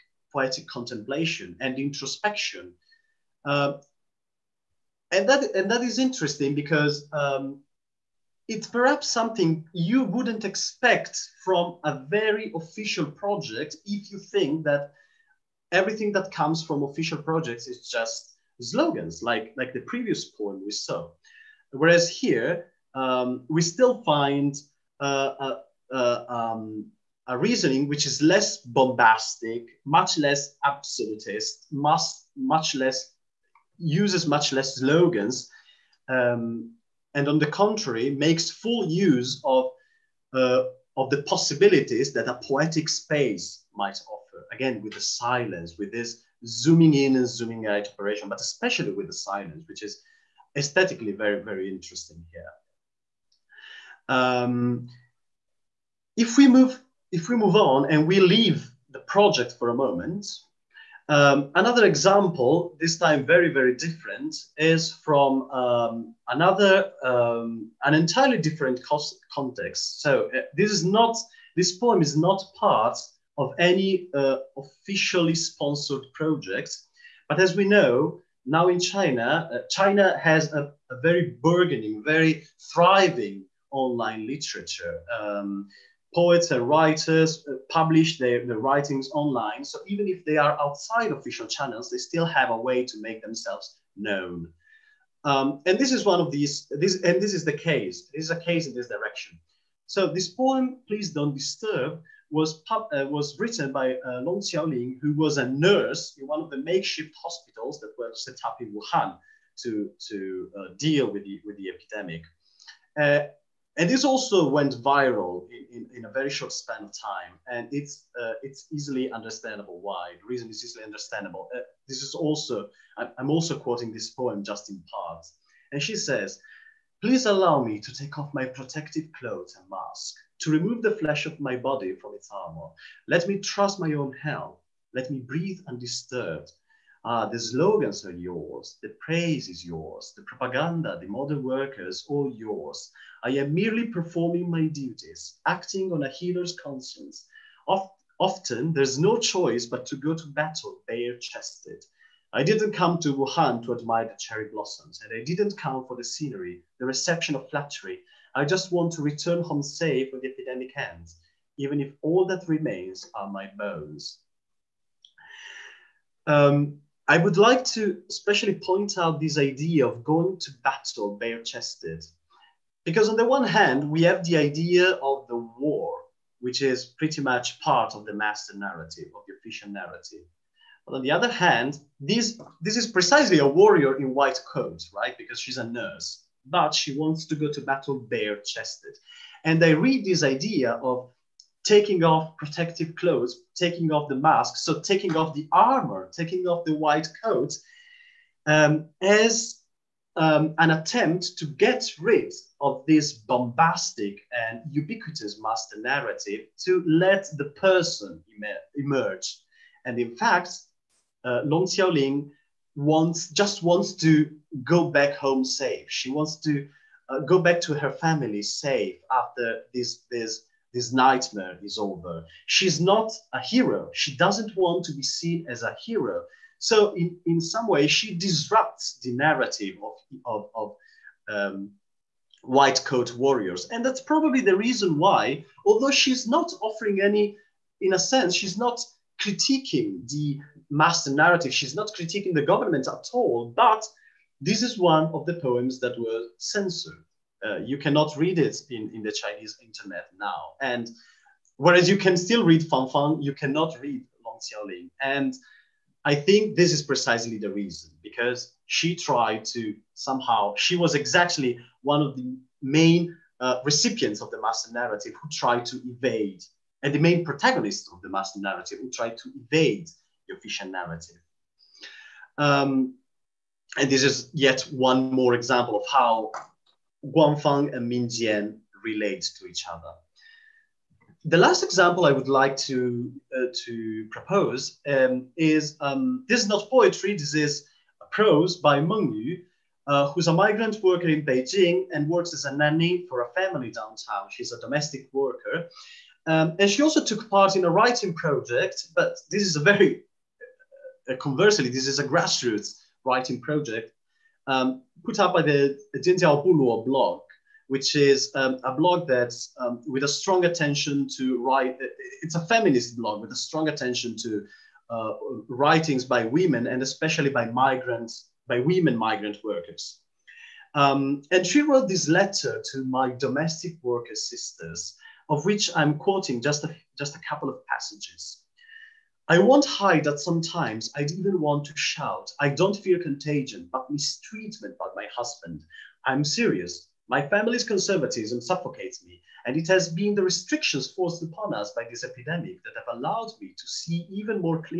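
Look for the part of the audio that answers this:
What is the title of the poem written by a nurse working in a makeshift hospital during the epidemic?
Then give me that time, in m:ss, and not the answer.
1:40.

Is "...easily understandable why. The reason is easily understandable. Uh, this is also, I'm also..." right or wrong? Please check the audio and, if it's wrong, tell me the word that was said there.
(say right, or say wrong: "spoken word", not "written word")
right.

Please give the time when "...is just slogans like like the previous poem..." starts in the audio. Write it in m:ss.
0:17.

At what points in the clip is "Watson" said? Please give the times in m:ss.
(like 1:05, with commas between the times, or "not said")
not said.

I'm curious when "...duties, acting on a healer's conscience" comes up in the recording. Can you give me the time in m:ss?
2:24.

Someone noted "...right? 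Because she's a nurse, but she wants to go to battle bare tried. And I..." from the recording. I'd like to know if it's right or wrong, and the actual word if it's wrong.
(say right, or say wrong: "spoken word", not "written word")
wrong: "chested", not "tried".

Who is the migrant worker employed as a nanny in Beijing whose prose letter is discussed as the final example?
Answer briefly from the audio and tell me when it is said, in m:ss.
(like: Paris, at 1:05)
Meng Yu, at 4:48.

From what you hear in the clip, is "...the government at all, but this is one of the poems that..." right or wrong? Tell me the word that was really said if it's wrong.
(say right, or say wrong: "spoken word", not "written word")
right.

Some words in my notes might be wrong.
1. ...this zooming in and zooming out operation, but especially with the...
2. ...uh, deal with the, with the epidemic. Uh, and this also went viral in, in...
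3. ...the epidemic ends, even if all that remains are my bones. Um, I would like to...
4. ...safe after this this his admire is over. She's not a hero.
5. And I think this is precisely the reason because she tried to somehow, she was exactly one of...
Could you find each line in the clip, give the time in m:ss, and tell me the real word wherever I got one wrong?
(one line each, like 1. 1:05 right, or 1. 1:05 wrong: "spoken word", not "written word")
1. 0:45 right
2. 1:50 right
3. 2:40 right
4. 3:38 wrong: "nightmare", not "admire"
5. 4:15 right.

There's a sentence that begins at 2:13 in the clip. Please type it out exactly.
Let me trust my own health.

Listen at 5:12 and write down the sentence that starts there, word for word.
It's a feminist blog with a strong attention to uh, writings by women and especially by migrants, by women migrant workers.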